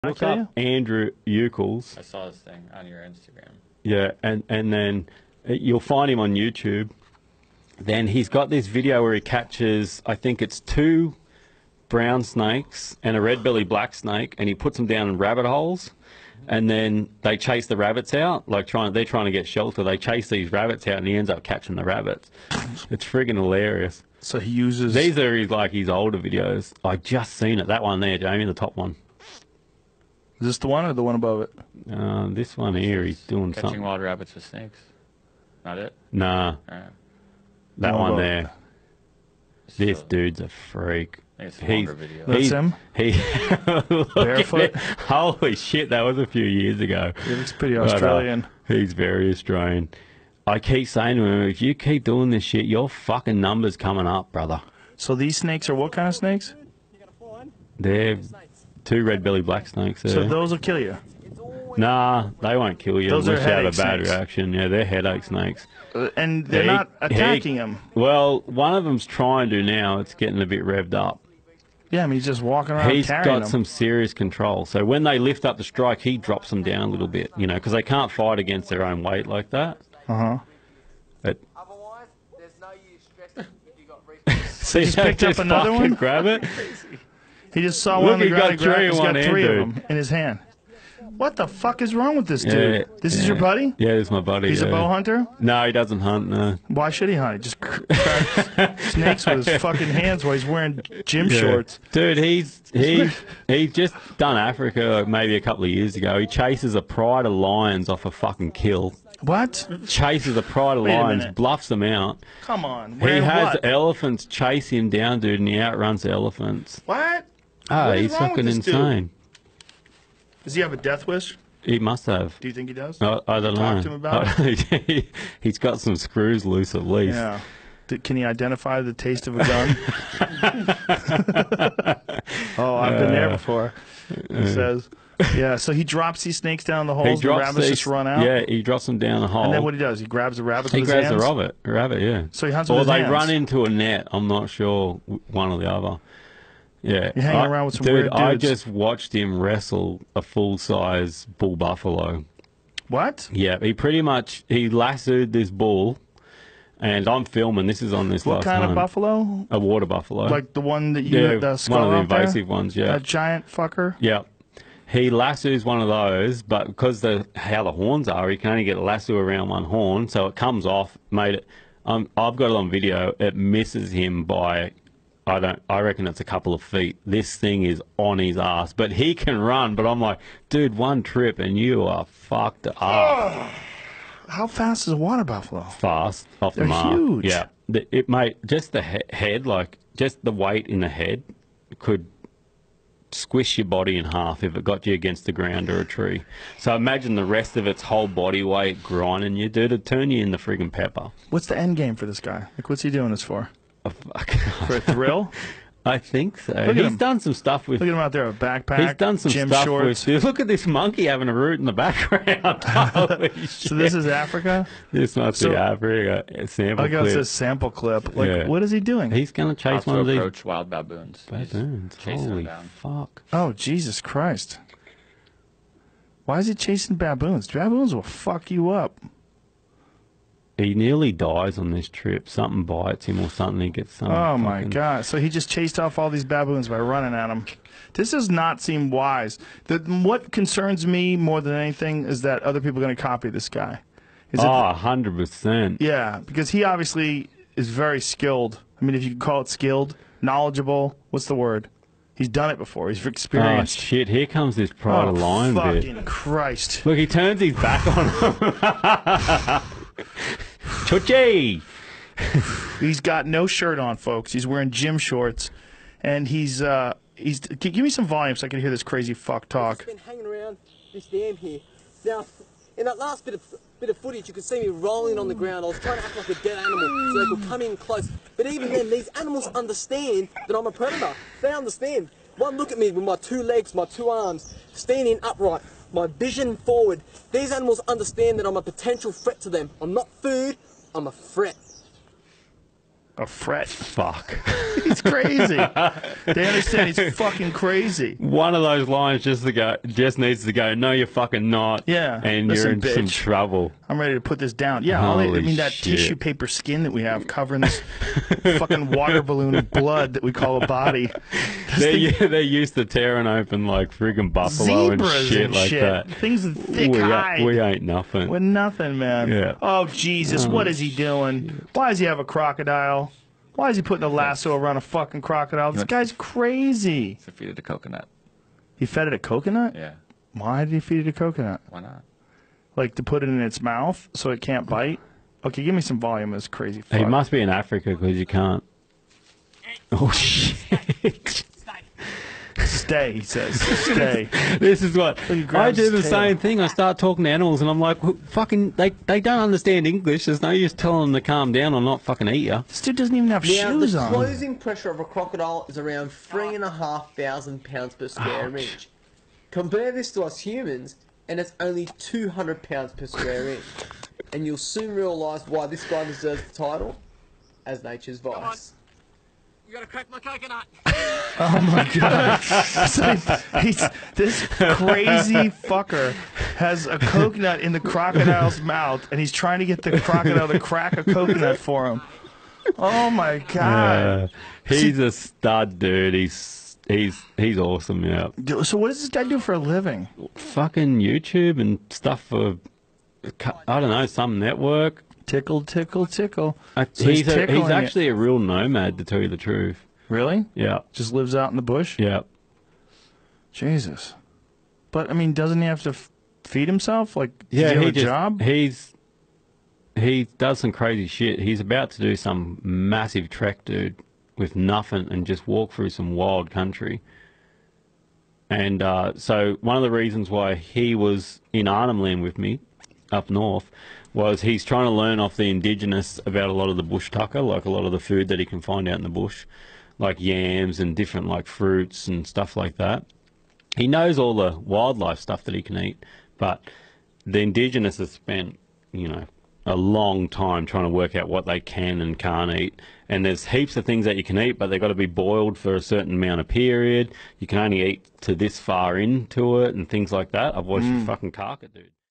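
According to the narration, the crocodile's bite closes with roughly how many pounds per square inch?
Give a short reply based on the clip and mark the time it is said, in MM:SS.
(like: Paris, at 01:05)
3,500, at 05:56.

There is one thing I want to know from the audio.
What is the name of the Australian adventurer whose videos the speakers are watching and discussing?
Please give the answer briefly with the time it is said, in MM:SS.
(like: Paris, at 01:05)
Andrew Ucles, at 00:00.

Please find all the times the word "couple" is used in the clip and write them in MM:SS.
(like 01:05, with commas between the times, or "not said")
01:45, 02:56.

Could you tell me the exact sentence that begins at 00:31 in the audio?
Uh, this one here, he's doing Catching something.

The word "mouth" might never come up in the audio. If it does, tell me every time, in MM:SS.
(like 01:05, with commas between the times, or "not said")
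05:33, 06:18.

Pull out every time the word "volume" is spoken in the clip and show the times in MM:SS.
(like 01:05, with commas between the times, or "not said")
04:28, 05:35.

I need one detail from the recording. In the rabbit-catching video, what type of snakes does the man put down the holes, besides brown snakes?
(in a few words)
red belly black snake.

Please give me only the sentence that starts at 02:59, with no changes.
But I'm like, dude, one trip and you are fucked up.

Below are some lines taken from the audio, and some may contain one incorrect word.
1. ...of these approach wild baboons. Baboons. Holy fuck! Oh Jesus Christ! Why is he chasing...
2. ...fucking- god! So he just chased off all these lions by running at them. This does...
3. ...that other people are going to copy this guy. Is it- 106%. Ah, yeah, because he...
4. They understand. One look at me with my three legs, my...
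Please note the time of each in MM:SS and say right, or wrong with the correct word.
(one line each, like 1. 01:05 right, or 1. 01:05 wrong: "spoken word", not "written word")
1. 03:39 right
2. 03:54 wrong: "baboons", not "lions"
3. 04:02 wrong: "100", not "106"
4. 04:41 wrong: "two", not "three".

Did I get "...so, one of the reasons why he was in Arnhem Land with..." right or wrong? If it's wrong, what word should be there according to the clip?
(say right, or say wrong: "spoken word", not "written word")
right.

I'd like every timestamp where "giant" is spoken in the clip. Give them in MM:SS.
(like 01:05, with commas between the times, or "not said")
02:42.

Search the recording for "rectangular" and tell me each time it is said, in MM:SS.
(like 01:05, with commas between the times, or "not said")
not said.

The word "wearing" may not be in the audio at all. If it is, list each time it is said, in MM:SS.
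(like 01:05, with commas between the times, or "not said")
01:40, 04:24.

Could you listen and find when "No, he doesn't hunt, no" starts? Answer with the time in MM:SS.
01:35.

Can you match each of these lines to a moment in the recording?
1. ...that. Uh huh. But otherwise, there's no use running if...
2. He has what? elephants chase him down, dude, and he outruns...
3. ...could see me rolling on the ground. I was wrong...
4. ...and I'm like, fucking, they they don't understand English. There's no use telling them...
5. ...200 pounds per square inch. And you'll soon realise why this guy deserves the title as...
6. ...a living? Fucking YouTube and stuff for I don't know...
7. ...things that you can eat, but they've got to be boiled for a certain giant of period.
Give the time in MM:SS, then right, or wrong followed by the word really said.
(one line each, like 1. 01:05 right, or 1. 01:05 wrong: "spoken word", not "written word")
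1. 01:19 wrong: "stressing", not "running"
2. 01:52 right
3. 04:34 wrong: "trying", not "wrong"
4. 05:47 right
5. 06:01 right
6. 06:29 right
7. 07:23 wrong: "amount", not "giant".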